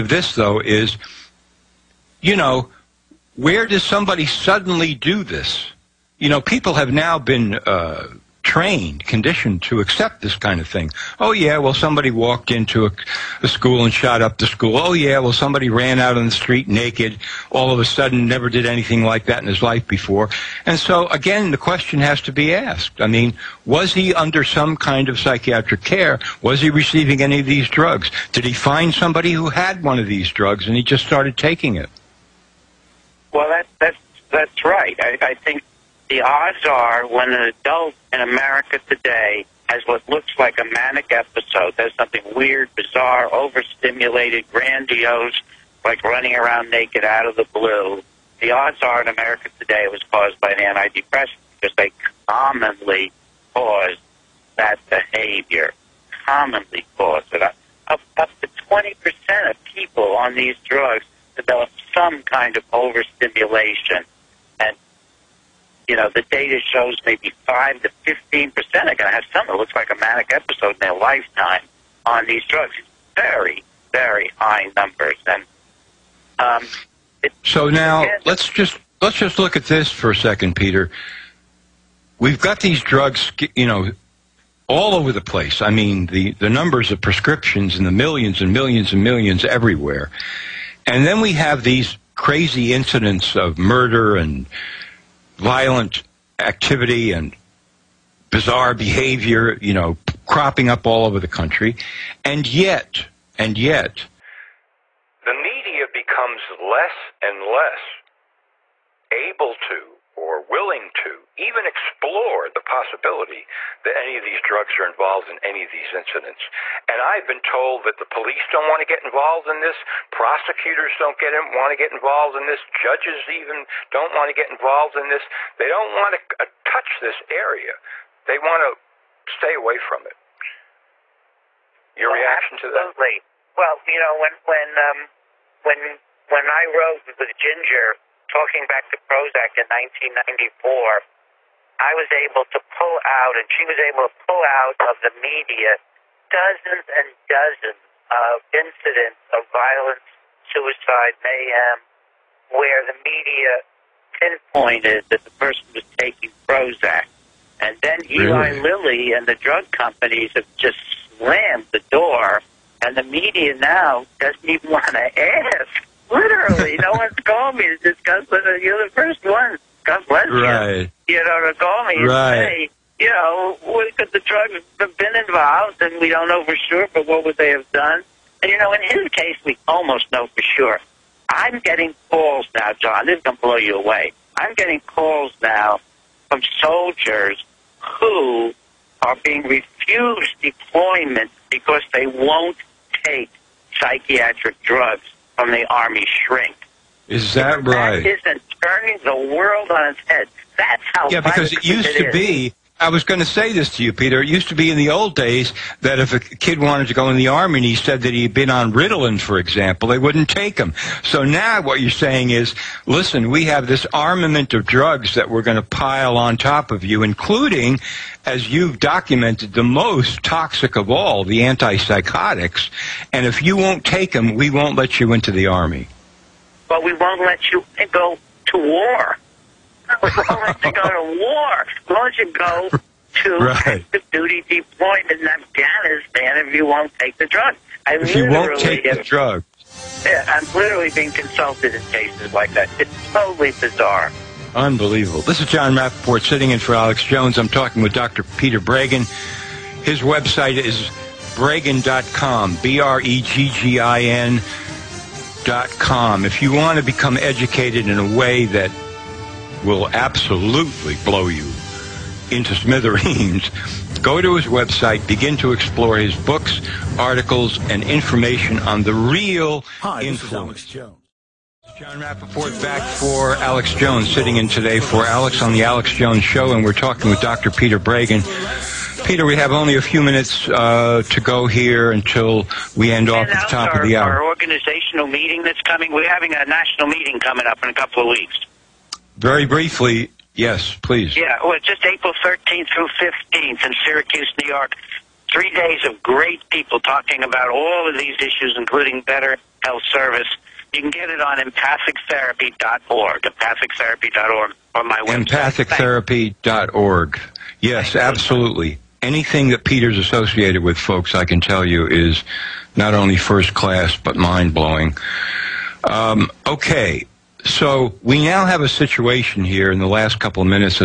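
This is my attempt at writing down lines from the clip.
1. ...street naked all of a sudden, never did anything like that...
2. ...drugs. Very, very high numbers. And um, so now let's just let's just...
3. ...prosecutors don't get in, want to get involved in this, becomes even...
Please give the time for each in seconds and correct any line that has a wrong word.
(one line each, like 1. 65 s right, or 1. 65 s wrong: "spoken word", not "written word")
1. 16 s right
2. 72 s right
3. 120 s wrong: "judges", not "becomes".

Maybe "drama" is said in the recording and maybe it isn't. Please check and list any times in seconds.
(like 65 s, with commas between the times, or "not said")
not said.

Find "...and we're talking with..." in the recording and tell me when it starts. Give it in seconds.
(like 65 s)
276 s.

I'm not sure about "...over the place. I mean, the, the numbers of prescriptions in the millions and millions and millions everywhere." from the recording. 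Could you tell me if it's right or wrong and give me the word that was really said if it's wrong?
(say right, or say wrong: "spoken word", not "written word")
right.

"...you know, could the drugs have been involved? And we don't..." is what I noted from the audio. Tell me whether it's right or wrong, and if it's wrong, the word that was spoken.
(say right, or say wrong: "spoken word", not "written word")
right.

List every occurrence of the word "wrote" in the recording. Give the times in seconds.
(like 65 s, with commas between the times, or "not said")
136 s.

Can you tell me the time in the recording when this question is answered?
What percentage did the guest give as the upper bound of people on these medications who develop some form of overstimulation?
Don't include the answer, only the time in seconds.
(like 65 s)
58 s.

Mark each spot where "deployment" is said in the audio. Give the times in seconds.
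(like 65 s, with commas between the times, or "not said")
190 s, 234 s.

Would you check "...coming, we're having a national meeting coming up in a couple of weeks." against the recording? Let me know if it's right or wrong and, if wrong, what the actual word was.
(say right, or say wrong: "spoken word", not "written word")
right.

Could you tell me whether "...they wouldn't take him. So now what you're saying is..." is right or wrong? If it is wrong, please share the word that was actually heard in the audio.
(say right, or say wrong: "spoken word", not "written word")
right.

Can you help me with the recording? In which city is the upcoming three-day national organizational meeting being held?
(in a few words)
Syracuse, New York.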